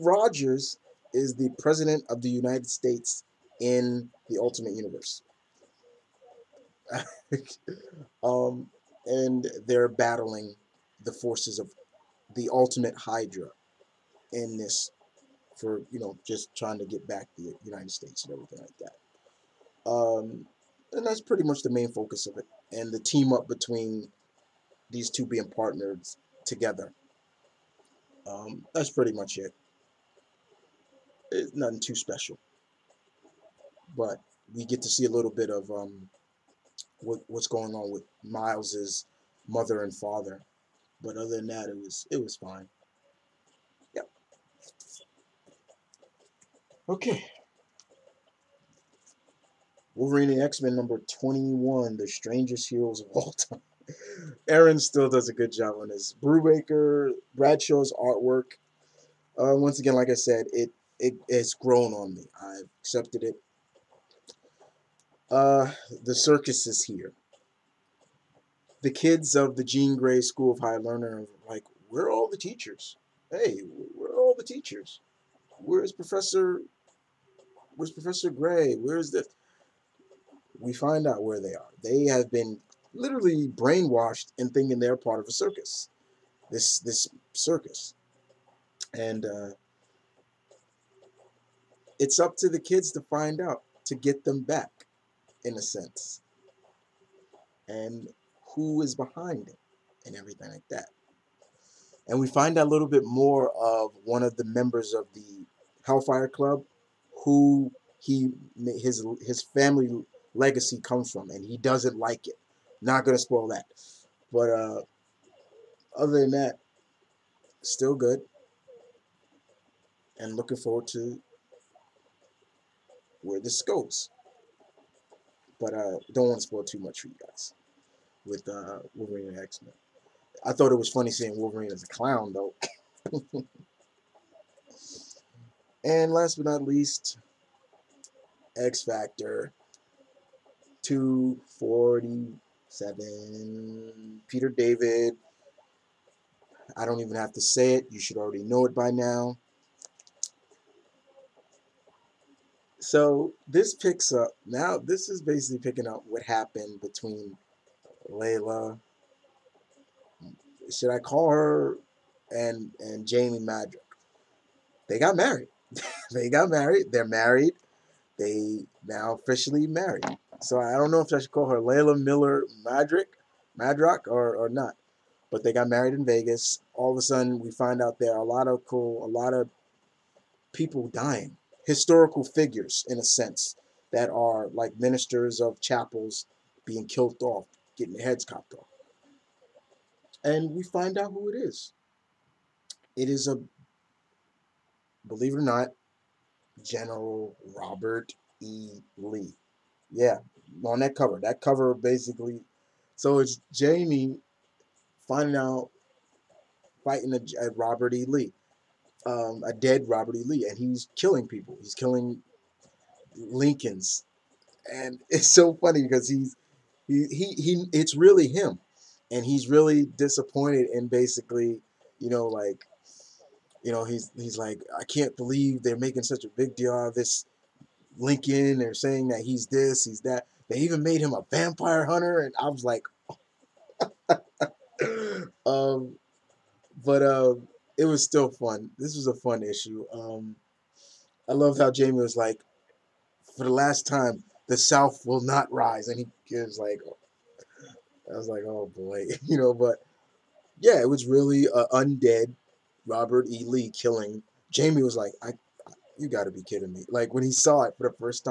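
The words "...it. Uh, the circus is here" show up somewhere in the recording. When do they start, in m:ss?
1:03.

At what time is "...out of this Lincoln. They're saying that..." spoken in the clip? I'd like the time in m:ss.
3:46.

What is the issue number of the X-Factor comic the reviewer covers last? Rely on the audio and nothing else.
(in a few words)
247.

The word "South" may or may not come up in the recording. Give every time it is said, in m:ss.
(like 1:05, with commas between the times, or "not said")
4:04.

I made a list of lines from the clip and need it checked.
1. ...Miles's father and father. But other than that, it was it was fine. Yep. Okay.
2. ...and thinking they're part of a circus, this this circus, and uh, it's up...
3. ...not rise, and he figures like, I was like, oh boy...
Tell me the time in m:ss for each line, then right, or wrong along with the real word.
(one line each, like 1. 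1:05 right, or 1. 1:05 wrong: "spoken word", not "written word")
1. 0:38 wrong: "mother", not "father"
2. 1:24 right
3. 4:05 wrong: "gives", not "figures".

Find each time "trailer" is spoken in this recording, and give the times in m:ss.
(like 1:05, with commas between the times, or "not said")
not said.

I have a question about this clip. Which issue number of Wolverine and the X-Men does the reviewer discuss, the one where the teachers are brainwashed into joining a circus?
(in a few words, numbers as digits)
21.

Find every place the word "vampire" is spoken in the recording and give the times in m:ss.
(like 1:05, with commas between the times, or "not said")
3:51.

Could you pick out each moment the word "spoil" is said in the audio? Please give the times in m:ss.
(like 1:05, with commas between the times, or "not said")
1:53, 2:06.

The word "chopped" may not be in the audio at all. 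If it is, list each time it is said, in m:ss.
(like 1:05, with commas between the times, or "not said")
3:08.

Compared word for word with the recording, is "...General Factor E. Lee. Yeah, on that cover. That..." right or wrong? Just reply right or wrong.
wrong.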